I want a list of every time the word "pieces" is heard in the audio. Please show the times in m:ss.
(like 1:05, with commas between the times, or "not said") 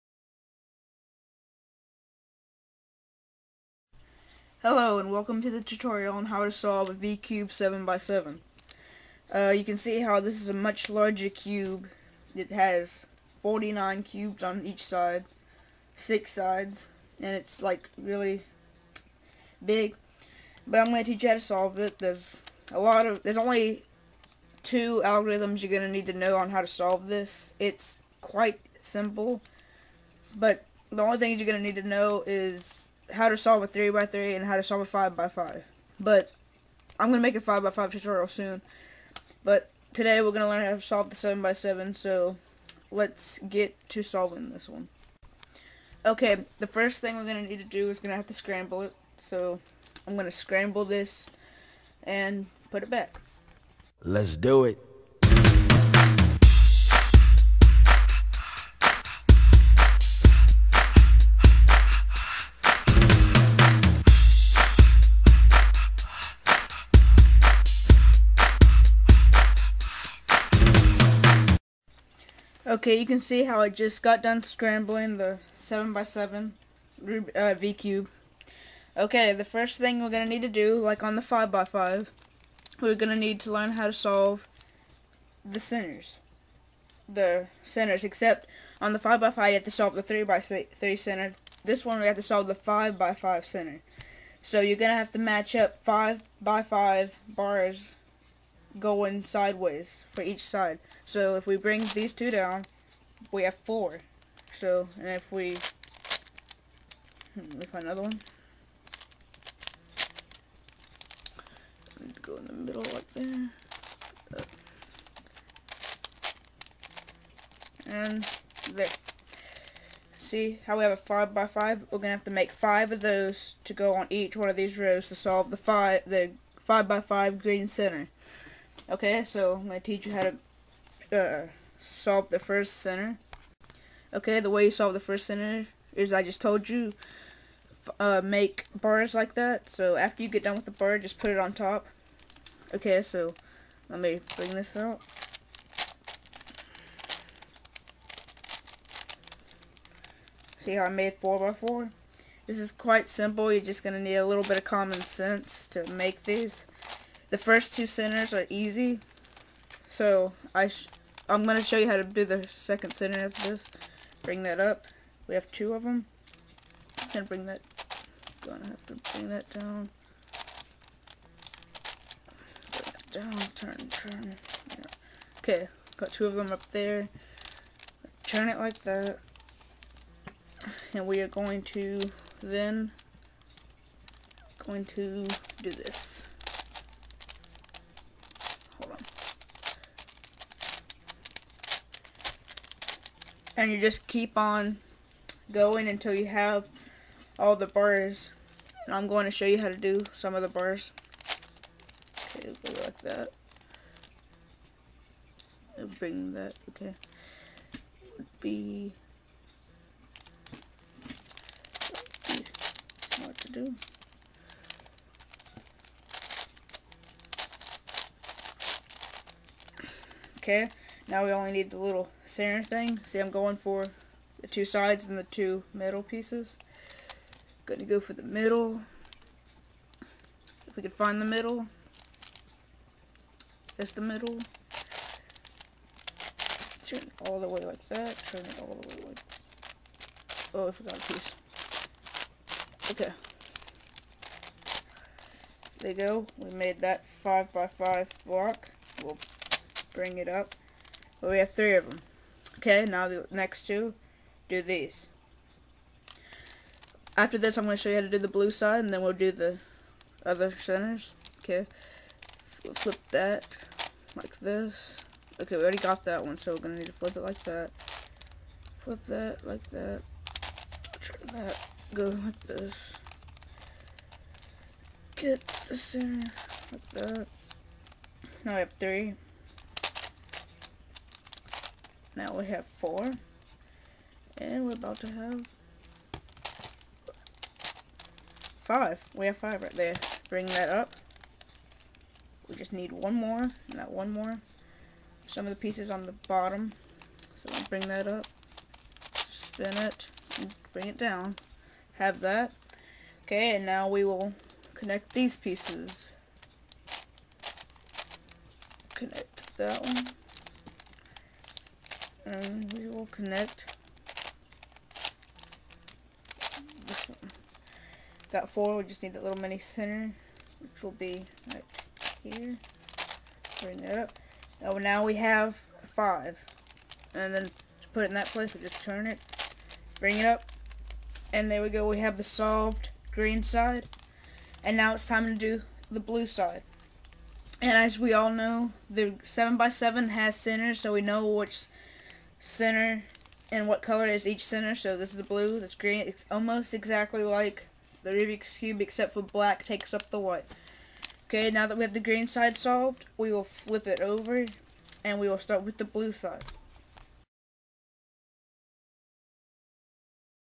3:46, 4:01, 4:55, 5:05.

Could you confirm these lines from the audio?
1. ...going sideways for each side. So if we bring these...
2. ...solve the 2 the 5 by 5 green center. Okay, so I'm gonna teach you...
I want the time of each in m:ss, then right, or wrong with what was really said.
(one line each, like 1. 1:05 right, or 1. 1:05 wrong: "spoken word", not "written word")
1. 1:38 right
2. 2:05 wrong: "5", not "2".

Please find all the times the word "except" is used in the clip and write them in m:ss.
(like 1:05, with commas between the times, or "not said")
1:28, 5:48.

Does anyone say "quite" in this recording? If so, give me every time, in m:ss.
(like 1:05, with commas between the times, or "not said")
0:28, 2:32.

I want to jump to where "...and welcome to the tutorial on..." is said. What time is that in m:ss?
0:04.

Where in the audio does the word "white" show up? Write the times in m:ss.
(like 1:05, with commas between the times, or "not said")
5:50.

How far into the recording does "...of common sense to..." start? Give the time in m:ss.
2:34.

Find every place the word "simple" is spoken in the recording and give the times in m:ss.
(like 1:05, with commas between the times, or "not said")
0:28, 2:33.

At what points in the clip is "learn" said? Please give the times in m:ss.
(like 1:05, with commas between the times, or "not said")
0:40, 1:23.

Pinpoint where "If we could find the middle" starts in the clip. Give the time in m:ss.
3:50.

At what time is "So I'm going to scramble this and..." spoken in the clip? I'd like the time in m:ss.
0:49.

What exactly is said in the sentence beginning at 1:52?
Go in the middle like there.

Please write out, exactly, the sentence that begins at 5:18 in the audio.
Got four, we just need that little mini center, which will be right here.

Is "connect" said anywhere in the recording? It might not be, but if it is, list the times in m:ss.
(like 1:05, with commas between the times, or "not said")
5:04, 5:08, 5:13.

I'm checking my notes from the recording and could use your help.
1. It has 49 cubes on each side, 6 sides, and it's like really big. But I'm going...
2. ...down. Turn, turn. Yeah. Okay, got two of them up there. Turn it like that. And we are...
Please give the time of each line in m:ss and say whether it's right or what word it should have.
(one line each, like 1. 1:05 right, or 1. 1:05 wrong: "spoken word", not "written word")
1. 0:12 right
2. 2:53 right.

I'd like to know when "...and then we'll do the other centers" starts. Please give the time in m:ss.
4:18.